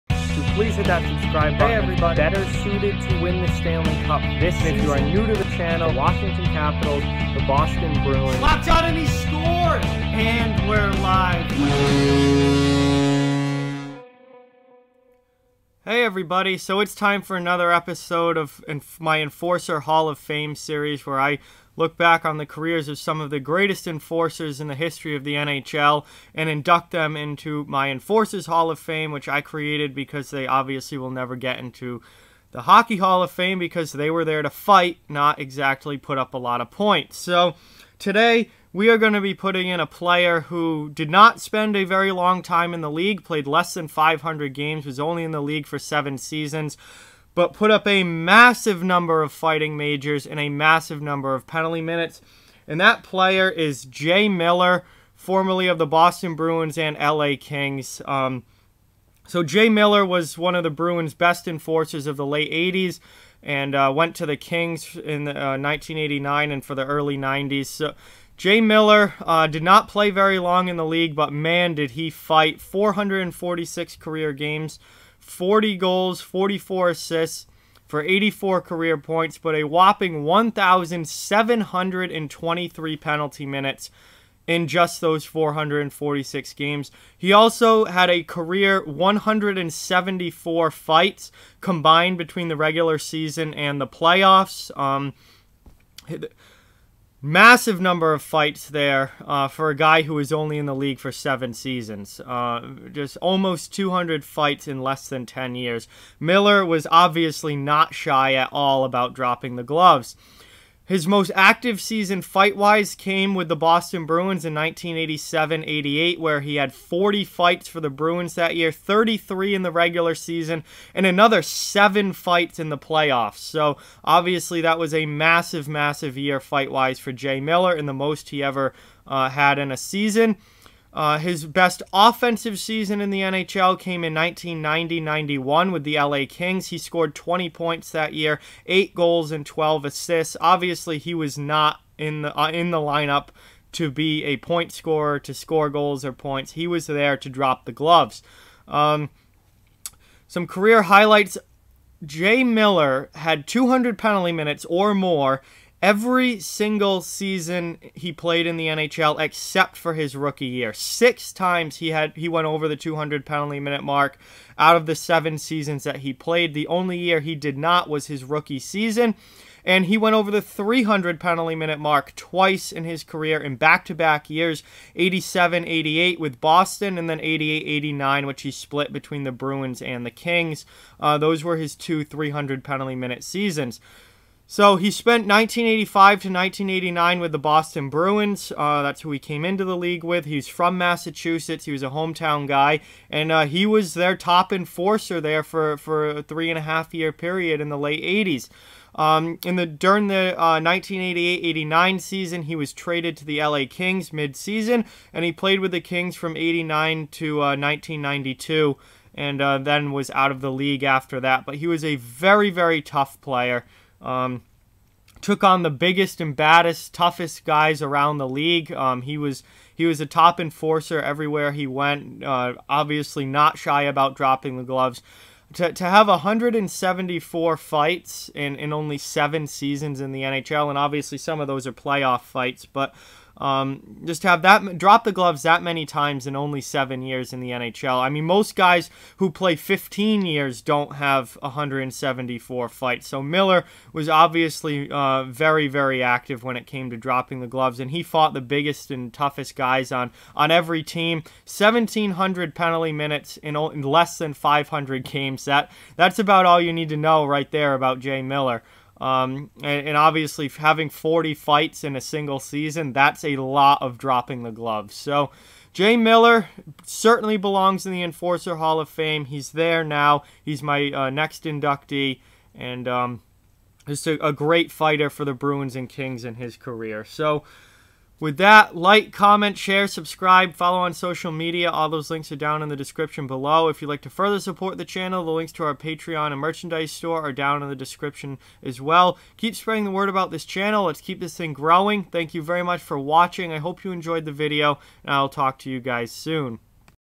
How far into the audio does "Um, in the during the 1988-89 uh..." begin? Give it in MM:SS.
03:18.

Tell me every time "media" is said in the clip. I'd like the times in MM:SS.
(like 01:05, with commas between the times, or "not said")
04:41.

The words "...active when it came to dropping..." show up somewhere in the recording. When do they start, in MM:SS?
04:06.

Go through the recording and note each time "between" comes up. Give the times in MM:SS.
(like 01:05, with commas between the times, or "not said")
01:32, 02:58.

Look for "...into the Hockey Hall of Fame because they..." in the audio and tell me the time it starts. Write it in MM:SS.
00:31.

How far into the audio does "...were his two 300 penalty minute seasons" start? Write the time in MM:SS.
03:01.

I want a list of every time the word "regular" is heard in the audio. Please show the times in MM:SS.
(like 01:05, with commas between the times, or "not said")
01:32, 01:59.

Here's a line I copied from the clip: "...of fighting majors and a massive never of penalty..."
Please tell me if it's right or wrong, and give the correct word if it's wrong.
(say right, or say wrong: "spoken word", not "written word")
wrong: "number", not "never".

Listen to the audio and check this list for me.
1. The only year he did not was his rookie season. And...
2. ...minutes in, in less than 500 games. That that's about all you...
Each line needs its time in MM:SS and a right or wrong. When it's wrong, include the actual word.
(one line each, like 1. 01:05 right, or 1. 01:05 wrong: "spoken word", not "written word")
1. 02:46 right
2. 04:12 right.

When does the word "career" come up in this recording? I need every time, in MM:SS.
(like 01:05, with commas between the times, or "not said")
00:22, 01:13, 01:18, 01:28, 02:30, 02:53, 04:36.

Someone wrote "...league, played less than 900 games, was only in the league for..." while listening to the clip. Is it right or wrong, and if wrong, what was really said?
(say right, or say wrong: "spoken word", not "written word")
wrong: "500", not "900".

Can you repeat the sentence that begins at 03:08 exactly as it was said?
Uh, that's who he came into the league with.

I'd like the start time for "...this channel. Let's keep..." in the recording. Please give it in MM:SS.
04:50.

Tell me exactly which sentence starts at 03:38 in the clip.
Um, he was he was a top enforcer everywhere he went.